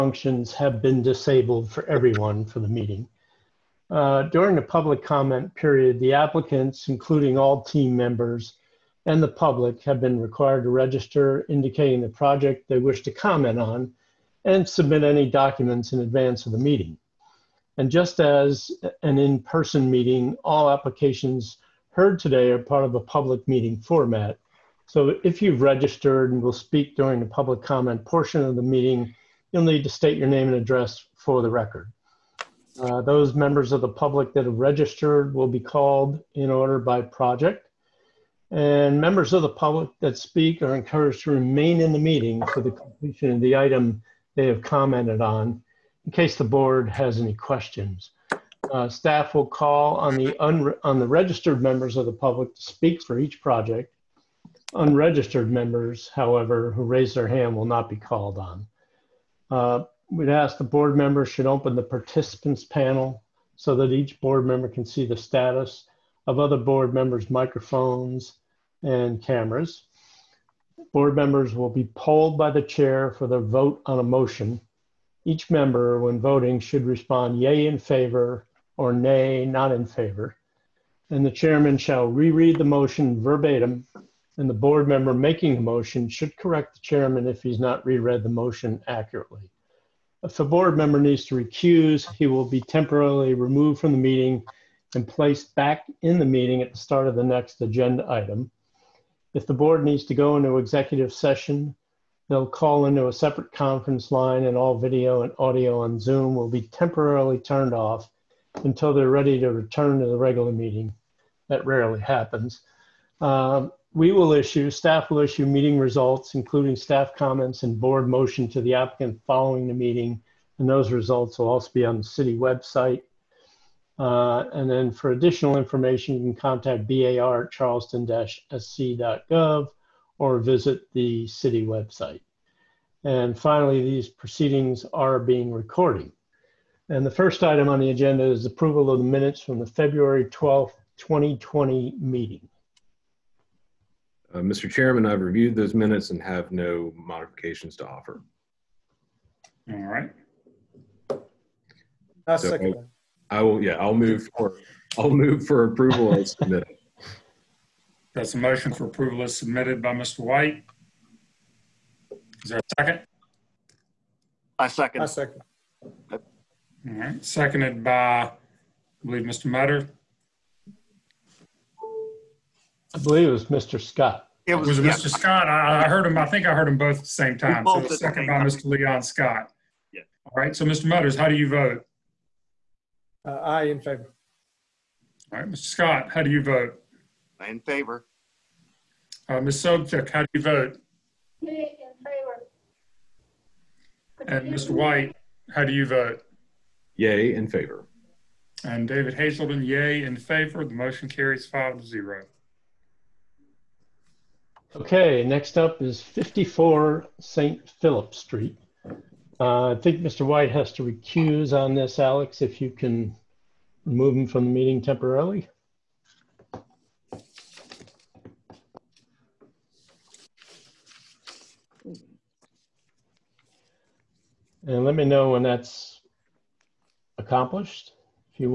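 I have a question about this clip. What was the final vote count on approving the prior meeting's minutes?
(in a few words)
5 to 0.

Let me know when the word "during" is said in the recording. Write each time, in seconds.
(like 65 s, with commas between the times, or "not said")
4 s, 26 s.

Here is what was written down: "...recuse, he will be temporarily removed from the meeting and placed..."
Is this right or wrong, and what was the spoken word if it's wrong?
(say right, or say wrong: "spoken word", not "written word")
right.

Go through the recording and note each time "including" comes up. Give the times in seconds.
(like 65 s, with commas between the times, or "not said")
6 s, 116 s.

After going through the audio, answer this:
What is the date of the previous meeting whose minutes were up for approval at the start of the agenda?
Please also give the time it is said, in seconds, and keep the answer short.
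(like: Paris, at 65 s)
February 12th, 2020, at 139 s.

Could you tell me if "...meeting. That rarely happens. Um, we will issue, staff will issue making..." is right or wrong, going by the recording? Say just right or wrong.
wrong.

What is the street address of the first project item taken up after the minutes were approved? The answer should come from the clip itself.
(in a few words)
54 St. Philip Street.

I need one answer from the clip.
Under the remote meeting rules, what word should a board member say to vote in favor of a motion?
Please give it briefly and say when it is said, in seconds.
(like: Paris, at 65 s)
yea, at 77 s.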